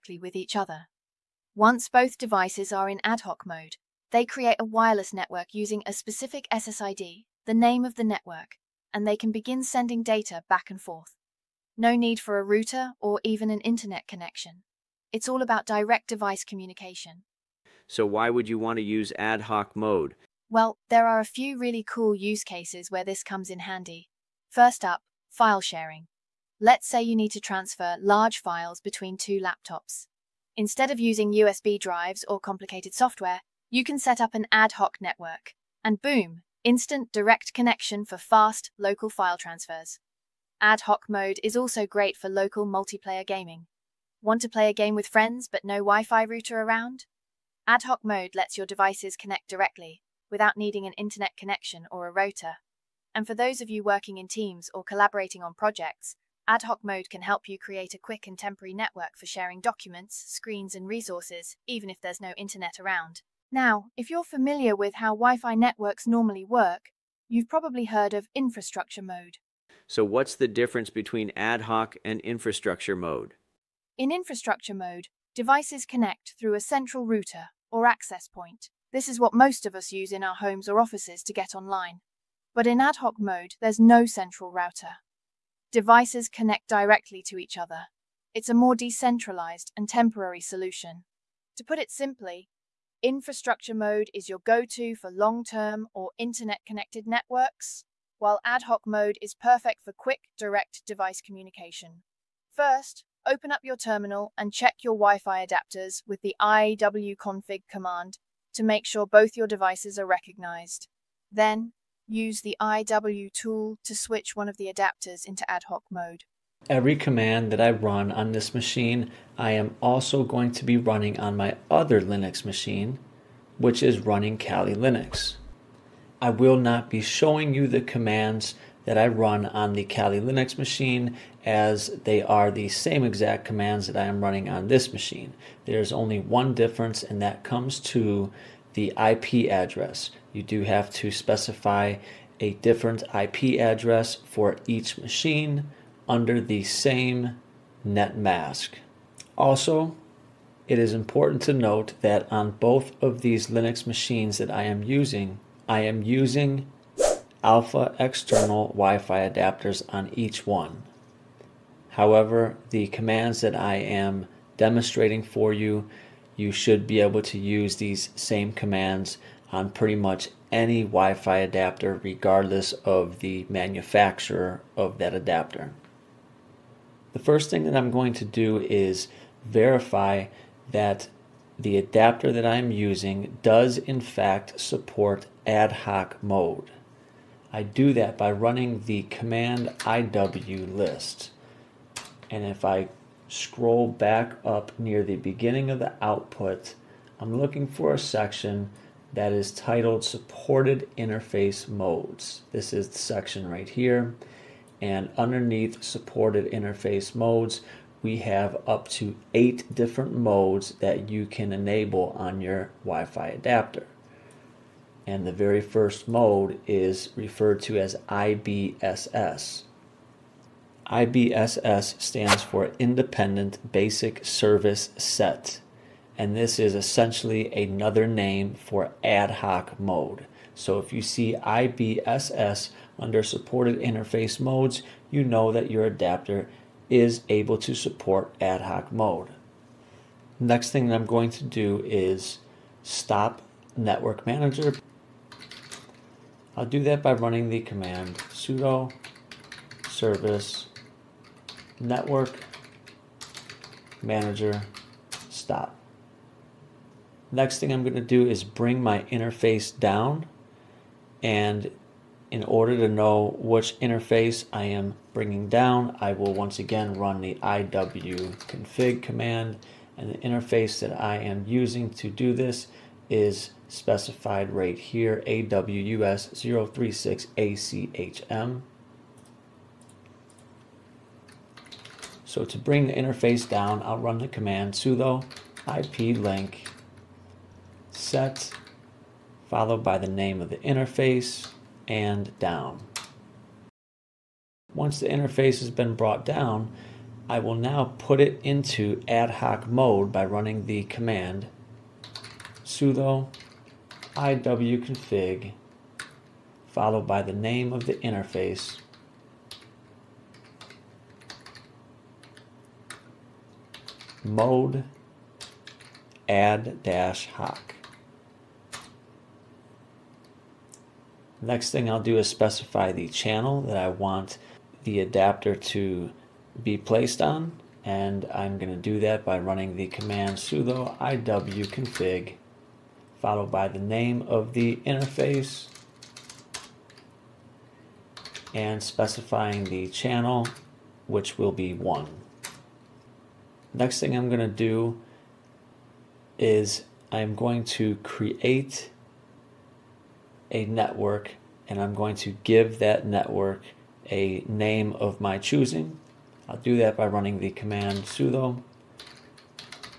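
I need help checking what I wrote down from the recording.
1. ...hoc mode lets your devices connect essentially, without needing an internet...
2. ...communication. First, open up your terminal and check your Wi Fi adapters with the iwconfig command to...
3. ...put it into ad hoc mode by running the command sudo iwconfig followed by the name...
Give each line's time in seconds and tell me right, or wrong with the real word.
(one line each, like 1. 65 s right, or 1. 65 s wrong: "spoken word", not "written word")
1. 47 s wrong: "directly", not "essentially"
2. 101 s right
3. 297 s right.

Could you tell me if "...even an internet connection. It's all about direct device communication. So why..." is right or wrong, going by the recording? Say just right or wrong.
right.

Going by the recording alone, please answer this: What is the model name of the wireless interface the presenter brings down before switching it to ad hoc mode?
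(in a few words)
AWUS 036ACHM.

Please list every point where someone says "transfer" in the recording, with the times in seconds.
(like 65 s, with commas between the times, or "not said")
27 s, 39 s.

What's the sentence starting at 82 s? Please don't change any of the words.
But in ad hoc mode, there's no central router.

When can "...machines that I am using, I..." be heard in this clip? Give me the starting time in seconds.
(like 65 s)
153 s.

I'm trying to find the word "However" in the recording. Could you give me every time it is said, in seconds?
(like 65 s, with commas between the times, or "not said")
161 s.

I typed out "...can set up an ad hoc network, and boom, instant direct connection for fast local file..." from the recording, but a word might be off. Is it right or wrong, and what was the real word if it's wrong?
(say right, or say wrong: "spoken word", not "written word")
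right.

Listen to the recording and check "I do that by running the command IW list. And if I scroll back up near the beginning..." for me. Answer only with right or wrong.
right.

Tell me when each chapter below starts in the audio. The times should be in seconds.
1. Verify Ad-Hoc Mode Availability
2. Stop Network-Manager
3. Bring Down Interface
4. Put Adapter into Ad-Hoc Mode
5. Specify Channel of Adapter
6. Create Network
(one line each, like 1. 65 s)
1. 176 s
2. 238 s
3. 263 s
4. 298 s
5. 323 s
6. 348 s.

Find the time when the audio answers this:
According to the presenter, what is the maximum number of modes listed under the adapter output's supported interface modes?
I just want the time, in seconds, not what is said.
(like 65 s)
209 s.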